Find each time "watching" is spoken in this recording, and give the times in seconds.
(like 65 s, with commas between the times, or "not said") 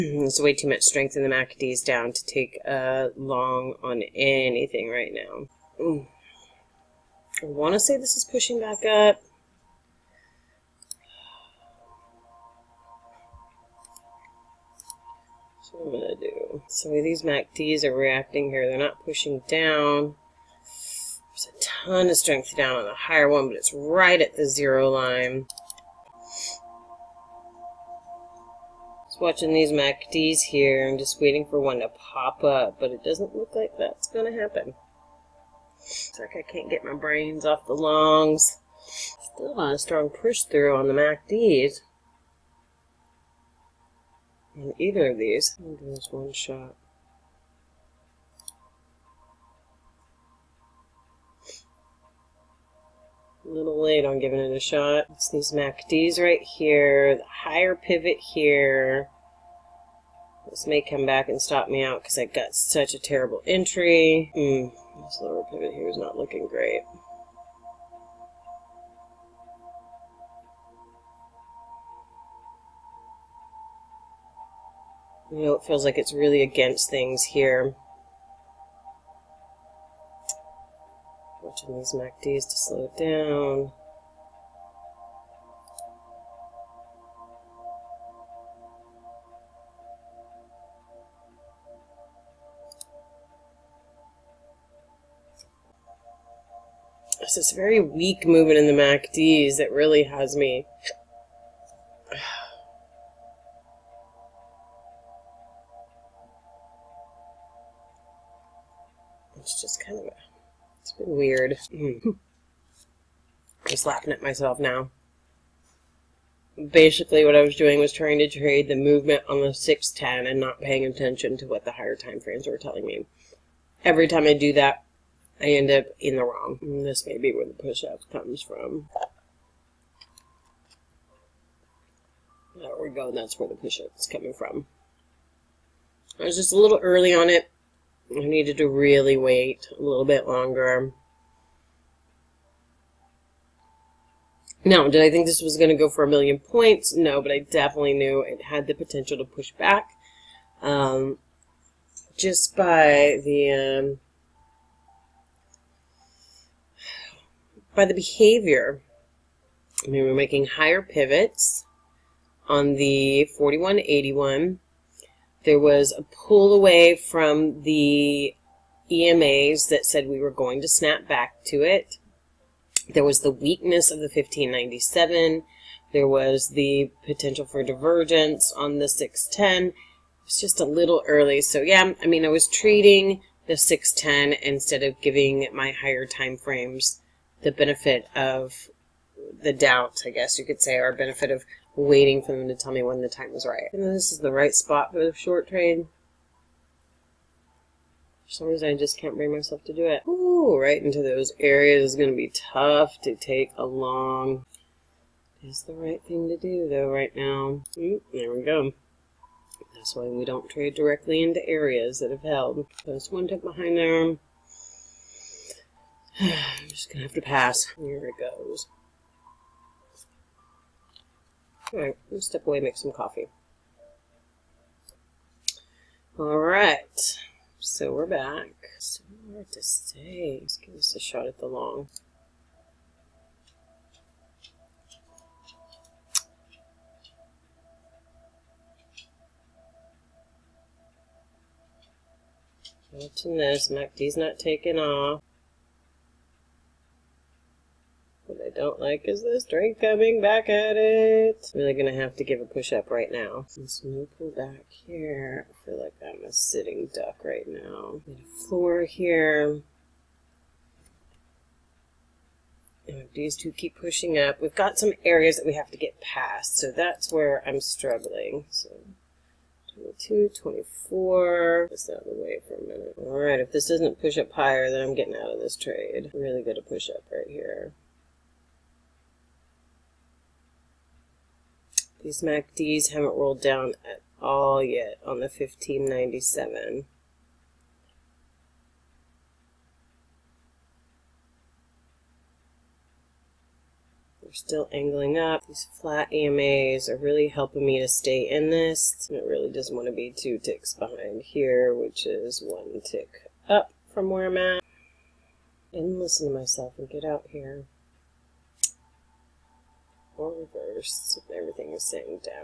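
29 s, 242 s.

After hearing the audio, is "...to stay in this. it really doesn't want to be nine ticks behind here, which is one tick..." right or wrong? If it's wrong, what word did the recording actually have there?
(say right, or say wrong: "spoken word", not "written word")
wrong: "two", not "nine".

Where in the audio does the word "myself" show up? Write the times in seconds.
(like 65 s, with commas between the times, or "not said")
114 s, 199 s, 306 s.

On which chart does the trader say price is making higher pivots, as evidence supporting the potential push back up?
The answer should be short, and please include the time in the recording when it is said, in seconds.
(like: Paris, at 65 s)
4181, at 163 s.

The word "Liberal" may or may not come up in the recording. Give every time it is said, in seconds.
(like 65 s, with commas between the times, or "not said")
not said.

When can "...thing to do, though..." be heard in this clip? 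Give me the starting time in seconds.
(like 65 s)
206 s.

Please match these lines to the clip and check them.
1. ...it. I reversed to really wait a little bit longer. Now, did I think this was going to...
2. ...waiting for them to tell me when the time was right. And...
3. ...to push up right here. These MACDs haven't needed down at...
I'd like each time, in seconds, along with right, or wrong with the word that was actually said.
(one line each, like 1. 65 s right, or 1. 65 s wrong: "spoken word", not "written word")
1. 137 s wrong: "needed", not "reversed"
2. 191 s right
3. 276 s wrong: "rolled", not "needed".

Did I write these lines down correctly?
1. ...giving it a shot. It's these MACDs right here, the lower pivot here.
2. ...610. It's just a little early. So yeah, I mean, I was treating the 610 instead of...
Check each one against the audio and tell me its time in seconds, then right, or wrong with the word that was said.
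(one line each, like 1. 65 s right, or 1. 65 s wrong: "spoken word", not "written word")
1. 54 s wrong: "higher", not "lower"
2. 178 s right.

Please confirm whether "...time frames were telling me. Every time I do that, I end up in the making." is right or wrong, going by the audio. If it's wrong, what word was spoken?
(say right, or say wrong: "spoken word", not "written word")
wrong: "wrong", not "making".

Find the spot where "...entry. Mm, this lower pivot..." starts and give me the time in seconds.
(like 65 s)
63 s.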